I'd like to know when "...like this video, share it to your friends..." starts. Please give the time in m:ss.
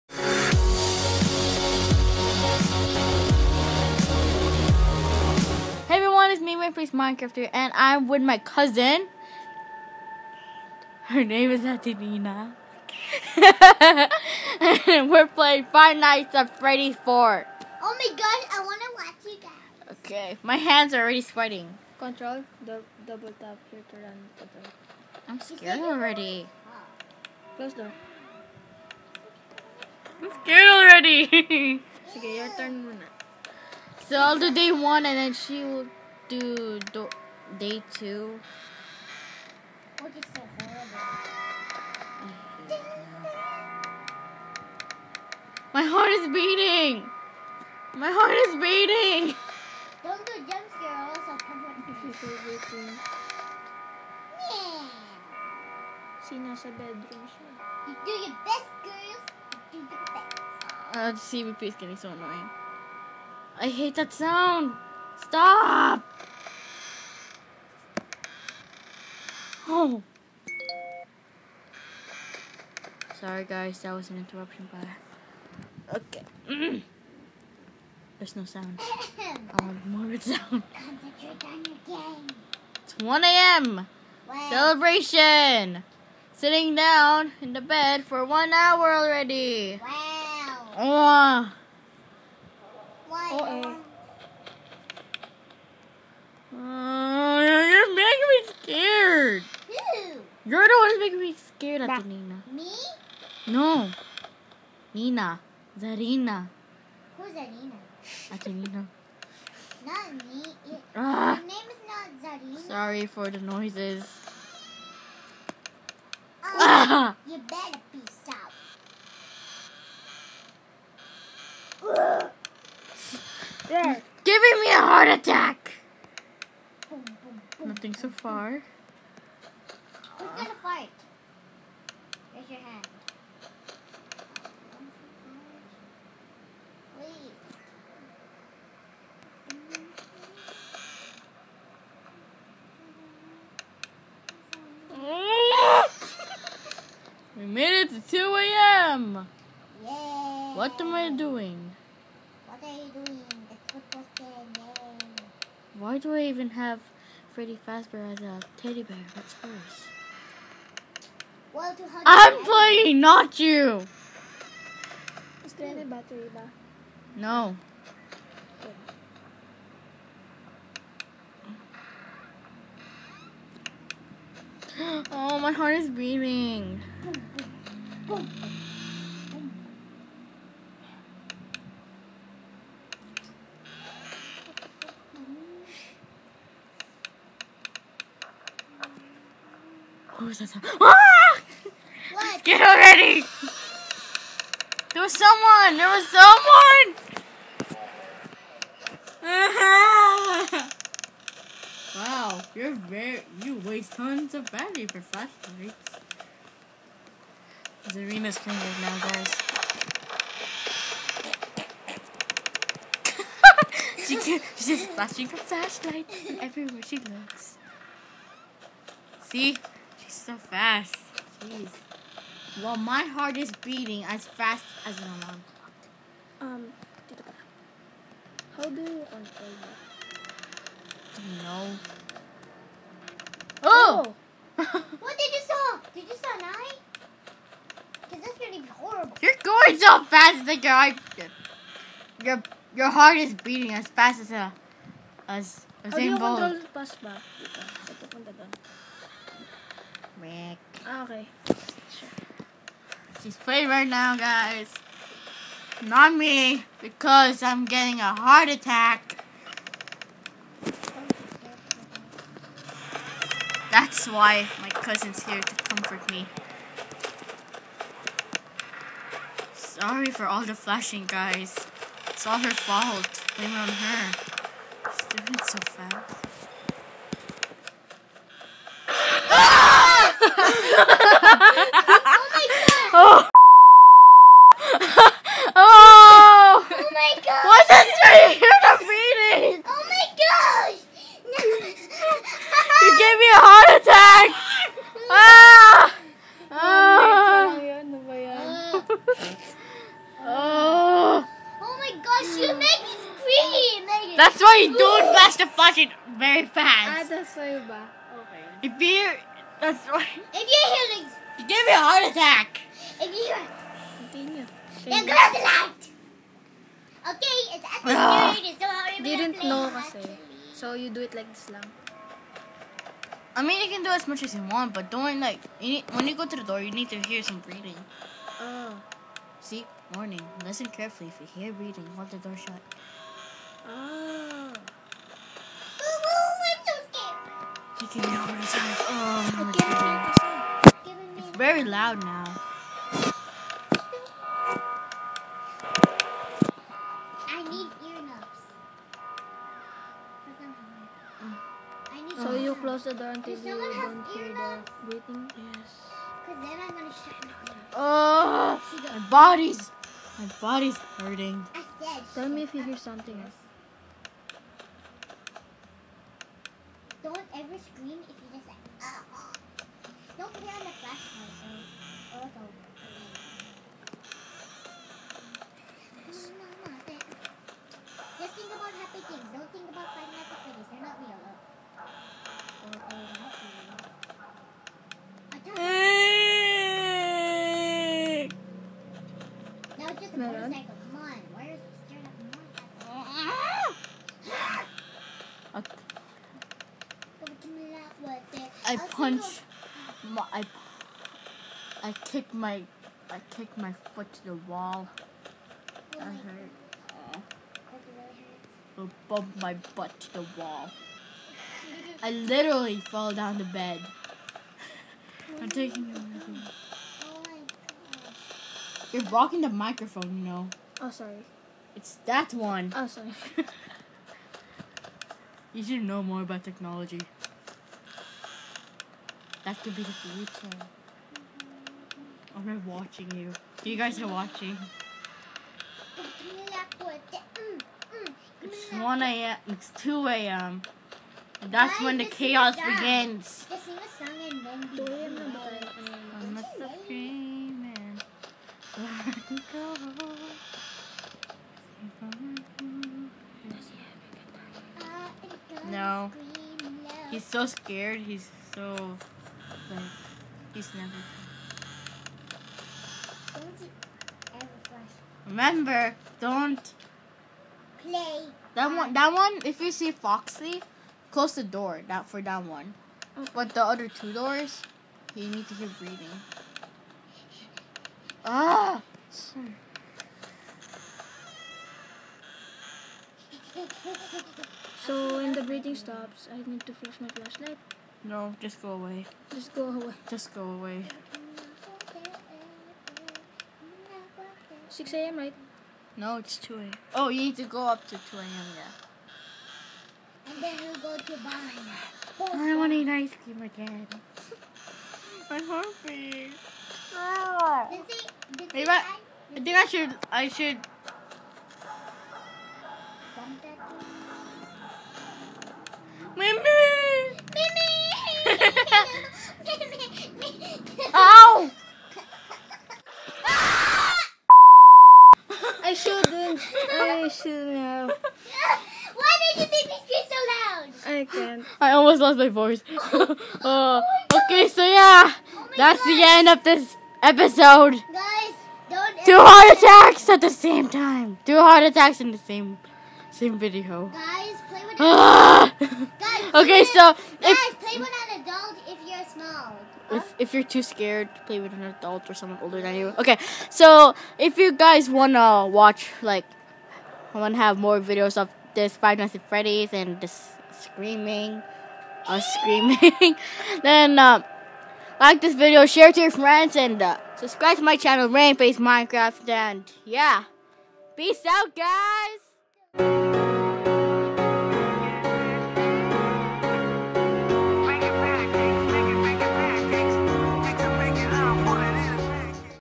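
9:24.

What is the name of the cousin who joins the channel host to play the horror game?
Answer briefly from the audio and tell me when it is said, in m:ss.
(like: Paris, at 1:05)
Adelina, at 0:11.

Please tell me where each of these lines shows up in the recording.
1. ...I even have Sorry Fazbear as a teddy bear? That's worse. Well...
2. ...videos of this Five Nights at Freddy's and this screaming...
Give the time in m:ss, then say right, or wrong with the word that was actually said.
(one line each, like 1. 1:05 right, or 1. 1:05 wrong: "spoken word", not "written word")
1. 2:36 wrong: "Freddy", not "Sorry"
2. 9:17 right.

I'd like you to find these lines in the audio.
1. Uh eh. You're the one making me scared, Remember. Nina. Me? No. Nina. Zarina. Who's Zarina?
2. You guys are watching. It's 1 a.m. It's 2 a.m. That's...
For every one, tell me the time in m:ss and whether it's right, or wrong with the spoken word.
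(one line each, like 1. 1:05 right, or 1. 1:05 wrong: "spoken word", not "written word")
1. 1:36 wrong: "Back", not "Remember"
2. 7:13 right.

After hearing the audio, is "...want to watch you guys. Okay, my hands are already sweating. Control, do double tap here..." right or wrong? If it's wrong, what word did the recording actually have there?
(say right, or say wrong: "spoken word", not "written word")
right.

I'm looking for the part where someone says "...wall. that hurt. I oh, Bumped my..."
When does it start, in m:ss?
6:44.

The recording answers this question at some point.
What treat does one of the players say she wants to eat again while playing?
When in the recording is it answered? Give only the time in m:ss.
8:22.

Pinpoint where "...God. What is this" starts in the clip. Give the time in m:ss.
4:47.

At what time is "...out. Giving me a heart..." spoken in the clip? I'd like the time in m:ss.
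2:01.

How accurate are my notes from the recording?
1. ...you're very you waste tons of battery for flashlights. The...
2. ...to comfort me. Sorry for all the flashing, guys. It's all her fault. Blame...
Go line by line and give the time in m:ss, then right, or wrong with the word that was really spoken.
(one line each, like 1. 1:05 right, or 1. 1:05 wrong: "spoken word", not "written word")
1. 3:22 right
2. 4:25 right.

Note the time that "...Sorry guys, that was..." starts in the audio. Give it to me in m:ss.
1:13.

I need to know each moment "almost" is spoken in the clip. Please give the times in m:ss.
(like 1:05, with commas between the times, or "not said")
8:51.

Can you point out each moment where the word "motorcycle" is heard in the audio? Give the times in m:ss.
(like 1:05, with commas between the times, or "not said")
6:30.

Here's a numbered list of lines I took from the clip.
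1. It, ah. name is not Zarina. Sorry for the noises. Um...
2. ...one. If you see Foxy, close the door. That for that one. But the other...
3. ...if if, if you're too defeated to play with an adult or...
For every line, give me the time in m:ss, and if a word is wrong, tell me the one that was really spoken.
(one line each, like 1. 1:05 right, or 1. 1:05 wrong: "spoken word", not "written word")
1. 1:50 right
2. 7:49 right
3. 9:07 wrong: "scared", not "defeated".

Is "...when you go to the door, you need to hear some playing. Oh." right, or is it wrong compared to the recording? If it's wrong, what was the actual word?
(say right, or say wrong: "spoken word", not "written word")
wrong: "breathing", not "playing".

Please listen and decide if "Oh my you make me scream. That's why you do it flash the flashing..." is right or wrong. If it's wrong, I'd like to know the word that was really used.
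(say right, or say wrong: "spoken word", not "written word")
right.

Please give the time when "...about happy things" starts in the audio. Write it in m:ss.
6:18.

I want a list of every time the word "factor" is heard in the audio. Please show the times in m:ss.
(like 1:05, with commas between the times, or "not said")
not said.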